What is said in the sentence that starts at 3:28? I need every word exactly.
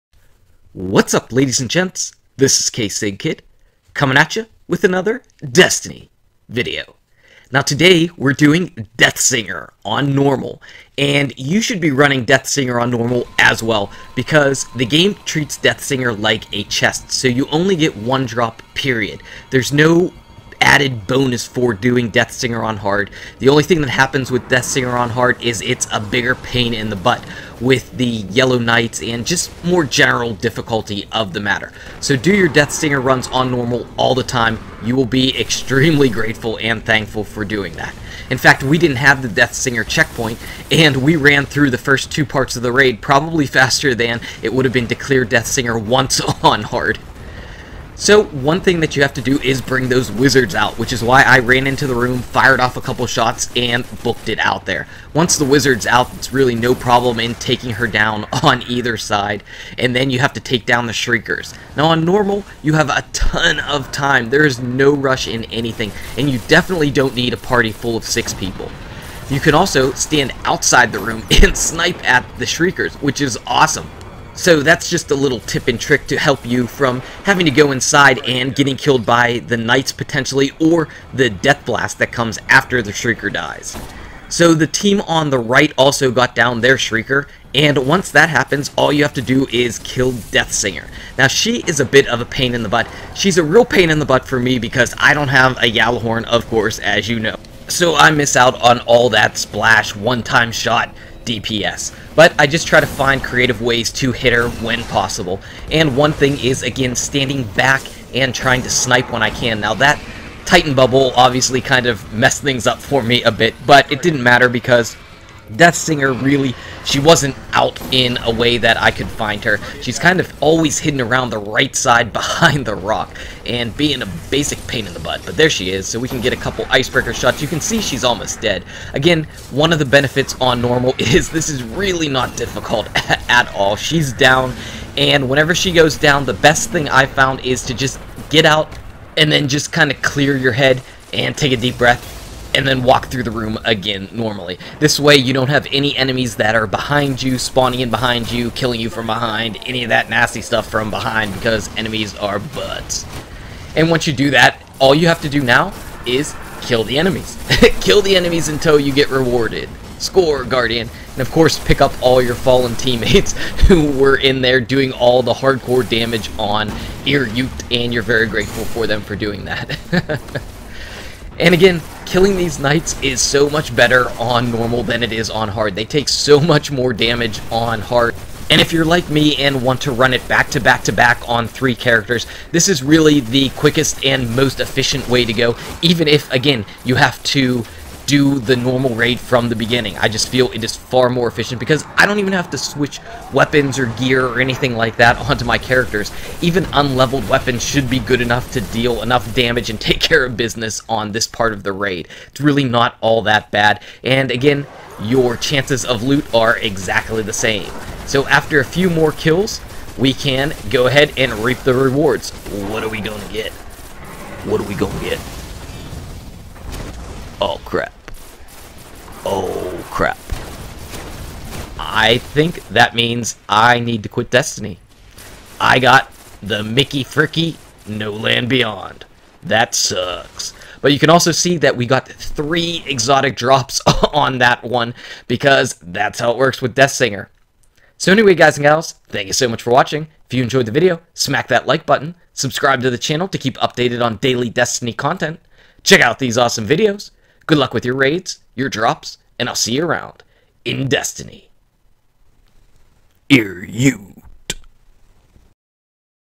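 So after a few more kills, we can go ahead and reap the rewards.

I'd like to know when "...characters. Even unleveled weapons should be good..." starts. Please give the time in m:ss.
3:15.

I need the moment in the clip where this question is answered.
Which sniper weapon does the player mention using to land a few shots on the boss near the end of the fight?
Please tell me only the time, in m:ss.
2:06.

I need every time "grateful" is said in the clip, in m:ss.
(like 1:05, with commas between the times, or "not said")
0:36, 2:48.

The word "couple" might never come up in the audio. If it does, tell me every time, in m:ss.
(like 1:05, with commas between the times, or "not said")
0:52, 2:06.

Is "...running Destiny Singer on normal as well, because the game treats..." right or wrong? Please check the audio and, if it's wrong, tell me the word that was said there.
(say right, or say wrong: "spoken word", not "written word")
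wrong: "Death", not "Destiny".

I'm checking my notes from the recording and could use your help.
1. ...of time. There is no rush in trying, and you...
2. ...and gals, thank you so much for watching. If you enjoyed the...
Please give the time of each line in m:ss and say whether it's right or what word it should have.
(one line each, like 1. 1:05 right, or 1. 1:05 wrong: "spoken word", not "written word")
1. 1:03 wrong: "anything", not "trying"
2. 3:58 right.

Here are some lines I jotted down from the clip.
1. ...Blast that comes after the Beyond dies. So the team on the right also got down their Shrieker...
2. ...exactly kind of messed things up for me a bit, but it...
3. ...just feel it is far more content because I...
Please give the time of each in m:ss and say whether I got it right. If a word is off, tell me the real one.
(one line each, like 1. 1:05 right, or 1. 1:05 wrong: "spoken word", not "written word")
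1. 1:21 wrong: "Shrieker", not "Beyond"
2. 1:51 wrong: "obviously", not "exactly"
3. 3:10 wrong: "efficient", not "content".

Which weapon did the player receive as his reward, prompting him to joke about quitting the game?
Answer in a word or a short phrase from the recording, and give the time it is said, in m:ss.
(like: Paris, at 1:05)
No Land Beyond, at 3:47.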